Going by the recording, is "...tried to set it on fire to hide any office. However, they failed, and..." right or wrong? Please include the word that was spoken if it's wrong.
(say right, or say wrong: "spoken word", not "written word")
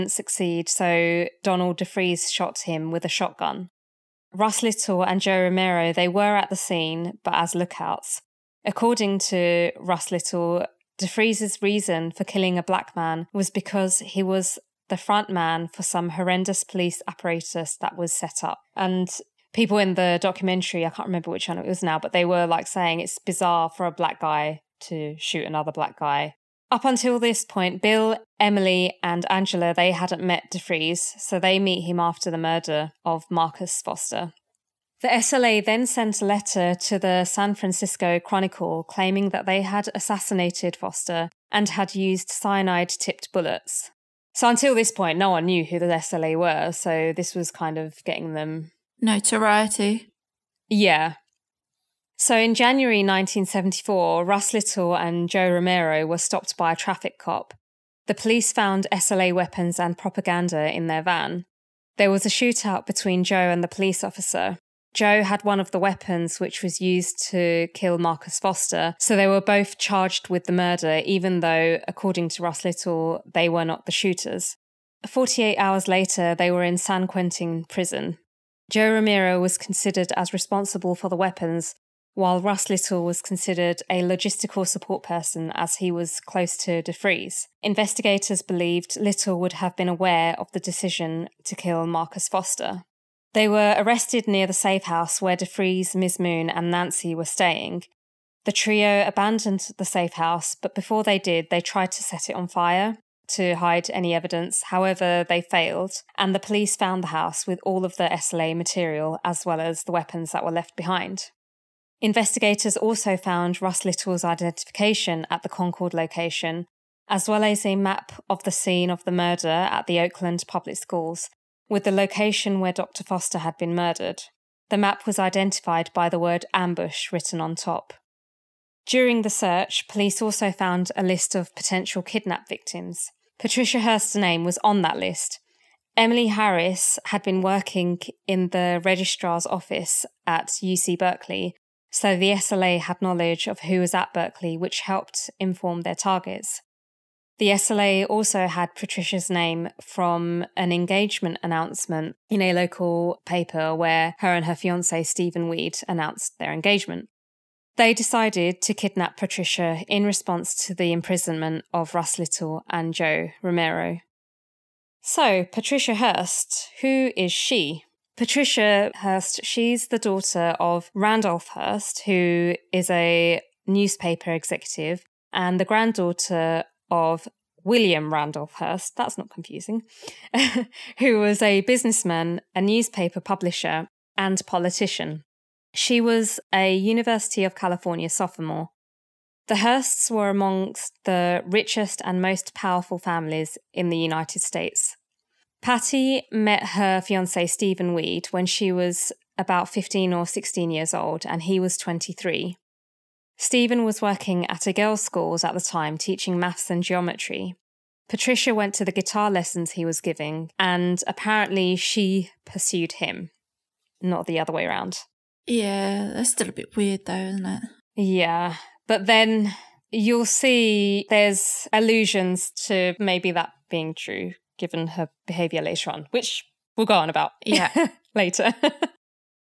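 wrong: "evidence", not "office".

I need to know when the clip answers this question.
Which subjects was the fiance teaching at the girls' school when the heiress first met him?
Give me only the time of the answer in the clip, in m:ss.
3:26.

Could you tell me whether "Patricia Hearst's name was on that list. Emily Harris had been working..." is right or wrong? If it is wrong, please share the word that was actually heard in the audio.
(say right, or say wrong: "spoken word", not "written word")
right.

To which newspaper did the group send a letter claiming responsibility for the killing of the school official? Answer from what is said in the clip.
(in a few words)
San Francisco Chronicle.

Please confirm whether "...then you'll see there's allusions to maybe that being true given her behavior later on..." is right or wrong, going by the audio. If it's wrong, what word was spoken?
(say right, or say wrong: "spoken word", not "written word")
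right.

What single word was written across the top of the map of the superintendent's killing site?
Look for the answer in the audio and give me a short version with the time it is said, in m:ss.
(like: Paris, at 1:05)
ambush, at 2:06.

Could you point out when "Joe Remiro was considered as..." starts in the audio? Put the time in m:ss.
1:18.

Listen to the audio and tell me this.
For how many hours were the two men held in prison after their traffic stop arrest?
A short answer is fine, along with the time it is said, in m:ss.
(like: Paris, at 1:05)
48, at 1:15.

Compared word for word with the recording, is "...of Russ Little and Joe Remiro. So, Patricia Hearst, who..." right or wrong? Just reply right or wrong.
right.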